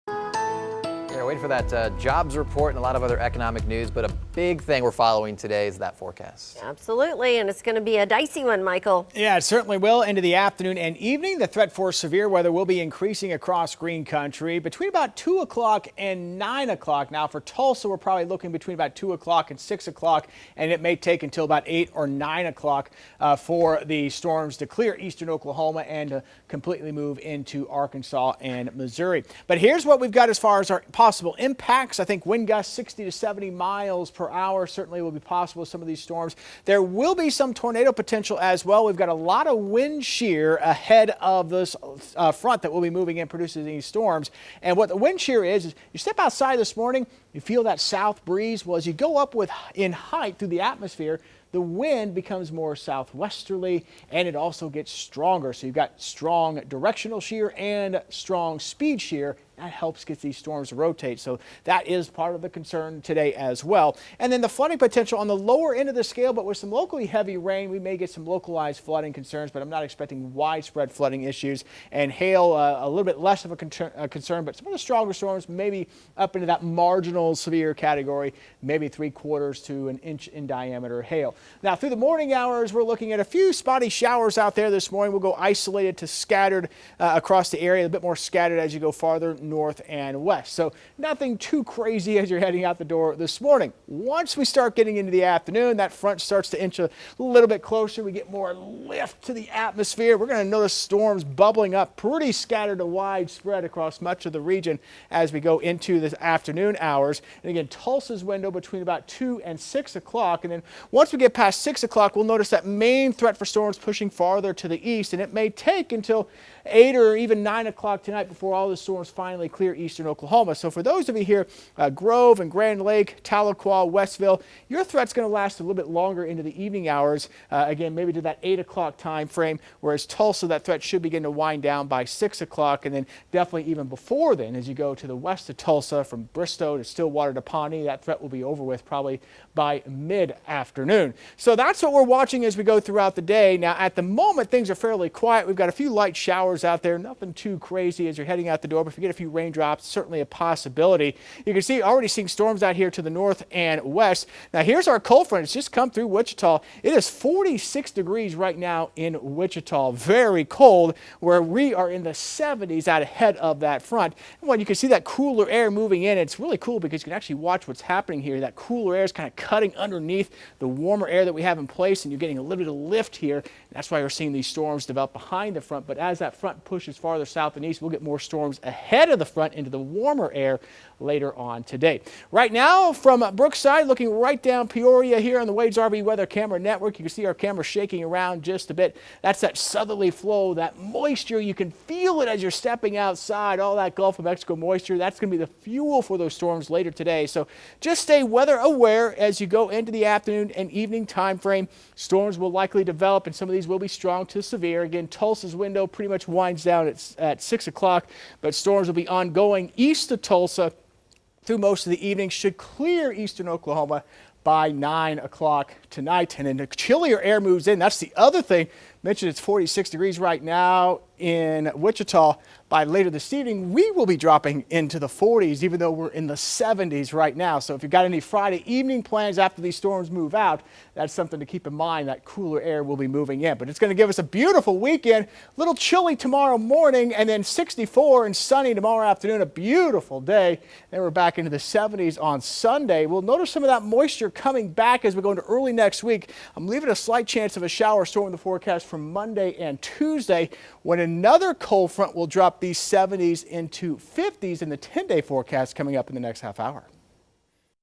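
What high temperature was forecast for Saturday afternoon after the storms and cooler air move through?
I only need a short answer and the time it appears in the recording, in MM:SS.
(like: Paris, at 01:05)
64, at 03:57.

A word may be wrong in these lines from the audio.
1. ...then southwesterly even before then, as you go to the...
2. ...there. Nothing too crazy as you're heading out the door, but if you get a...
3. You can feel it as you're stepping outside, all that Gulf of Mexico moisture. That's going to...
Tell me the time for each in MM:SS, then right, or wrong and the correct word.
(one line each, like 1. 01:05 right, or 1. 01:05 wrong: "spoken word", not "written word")
1. 02:12 wrong: "definitely", not "southwesterly"
2. 02:26 right
3. 03:11 right.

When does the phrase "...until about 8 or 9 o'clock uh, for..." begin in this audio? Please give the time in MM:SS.
00:21.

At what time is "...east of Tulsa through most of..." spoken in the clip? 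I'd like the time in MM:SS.
03:29.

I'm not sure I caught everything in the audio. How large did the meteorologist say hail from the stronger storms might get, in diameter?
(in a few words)
3/4 to 1 inch.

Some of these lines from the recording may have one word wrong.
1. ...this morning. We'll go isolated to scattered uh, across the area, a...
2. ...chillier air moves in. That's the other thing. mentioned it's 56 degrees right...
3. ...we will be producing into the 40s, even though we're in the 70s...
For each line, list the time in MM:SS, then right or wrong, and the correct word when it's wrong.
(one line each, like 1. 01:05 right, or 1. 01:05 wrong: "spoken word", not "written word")
1. 01:24 right
2. 03:36 wrong: "46", not "56"
3. 03:43 wrong: "dropping", not "producing".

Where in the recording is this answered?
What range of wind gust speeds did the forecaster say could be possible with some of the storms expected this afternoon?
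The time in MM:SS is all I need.
00:32.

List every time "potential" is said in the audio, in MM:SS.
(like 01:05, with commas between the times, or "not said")
00:37, 01:04.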